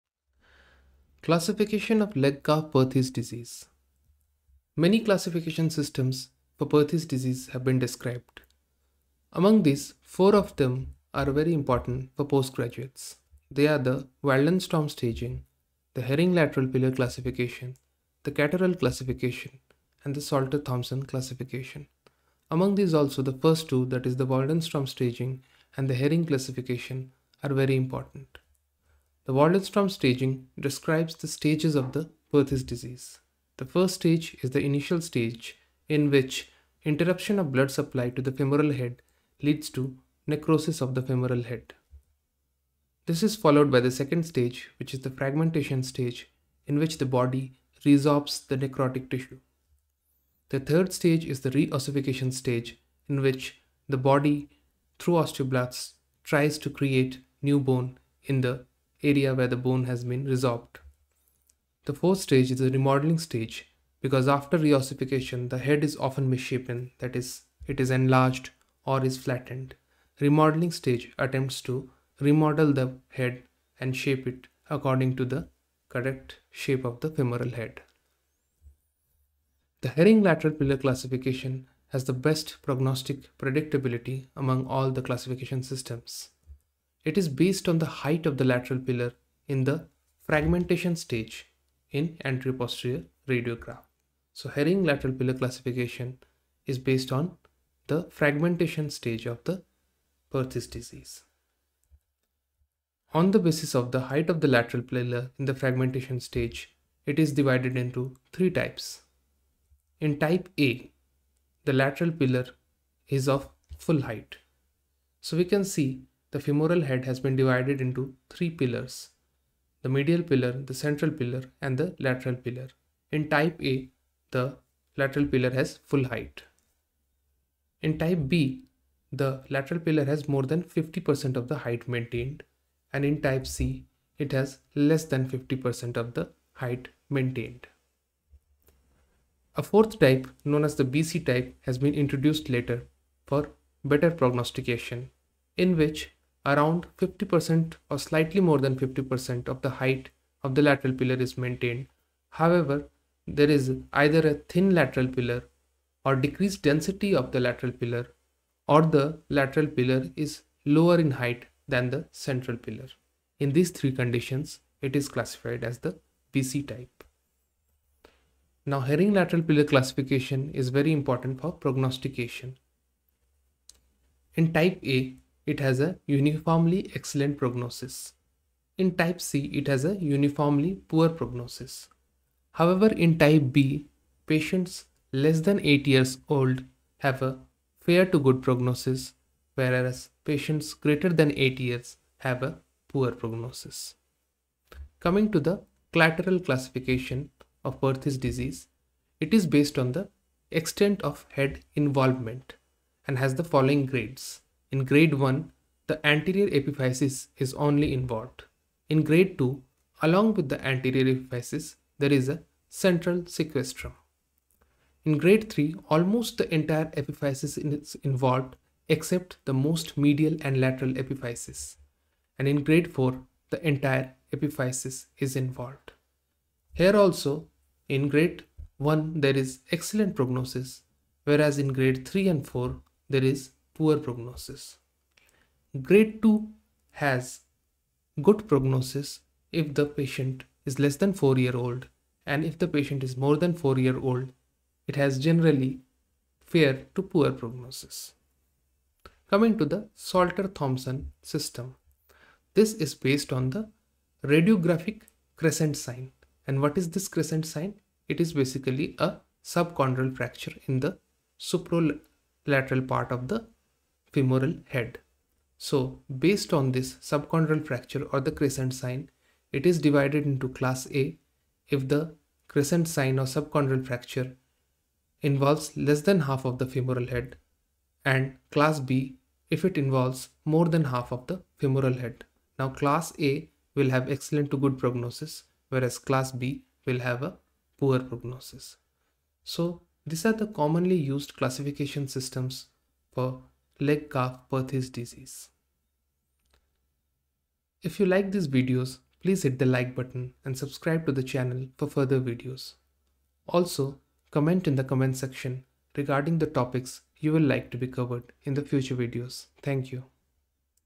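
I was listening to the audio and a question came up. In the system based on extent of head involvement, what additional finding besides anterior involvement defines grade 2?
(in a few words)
central sequestrum.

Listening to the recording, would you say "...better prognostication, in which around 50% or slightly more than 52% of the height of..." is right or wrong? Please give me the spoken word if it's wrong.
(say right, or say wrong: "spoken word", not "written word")
wrong: "50", not "52".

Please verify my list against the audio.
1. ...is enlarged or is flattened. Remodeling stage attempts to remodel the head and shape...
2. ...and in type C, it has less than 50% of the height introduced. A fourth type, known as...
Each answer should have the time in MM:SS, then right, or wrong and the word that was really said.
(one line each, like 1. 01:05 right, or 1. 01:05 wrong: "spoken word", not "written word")
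1. 01:07 right
2. 02:12 wrong: "maintained", not "introduced".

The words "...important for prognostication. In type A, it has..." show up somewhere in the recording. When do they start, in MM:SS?
02:50.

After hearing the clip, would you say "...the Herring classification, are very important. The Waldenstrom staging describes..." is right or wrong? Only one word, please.
right.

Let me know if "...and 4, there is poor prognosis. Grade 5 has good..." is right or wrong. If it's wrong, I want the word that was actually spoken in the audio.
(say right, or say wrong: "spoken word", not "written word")
wrong: "2", not "5".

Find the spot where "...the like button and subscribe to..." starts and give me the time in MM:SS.
04:59.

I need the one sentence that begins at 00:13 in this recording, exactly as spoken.
They are the Waldenstrom staging, the Herring lateral pillar classification, the Catterall classification, and the Salter Thompson classification.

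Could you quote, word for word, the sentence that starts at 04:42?
Now class A will have excellent to good prognosis whereas class B will have a poor prognosis.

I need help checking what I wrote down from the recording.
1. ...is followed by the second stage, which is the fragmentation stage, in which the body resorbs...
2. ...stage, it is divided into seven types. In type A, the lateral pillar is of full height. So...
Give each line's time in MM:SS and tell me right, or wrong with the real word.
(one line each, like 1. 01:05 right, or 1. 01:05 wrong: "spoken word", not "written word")
1. 00:43 right
2. 01:46 wrong: "three", not "seven".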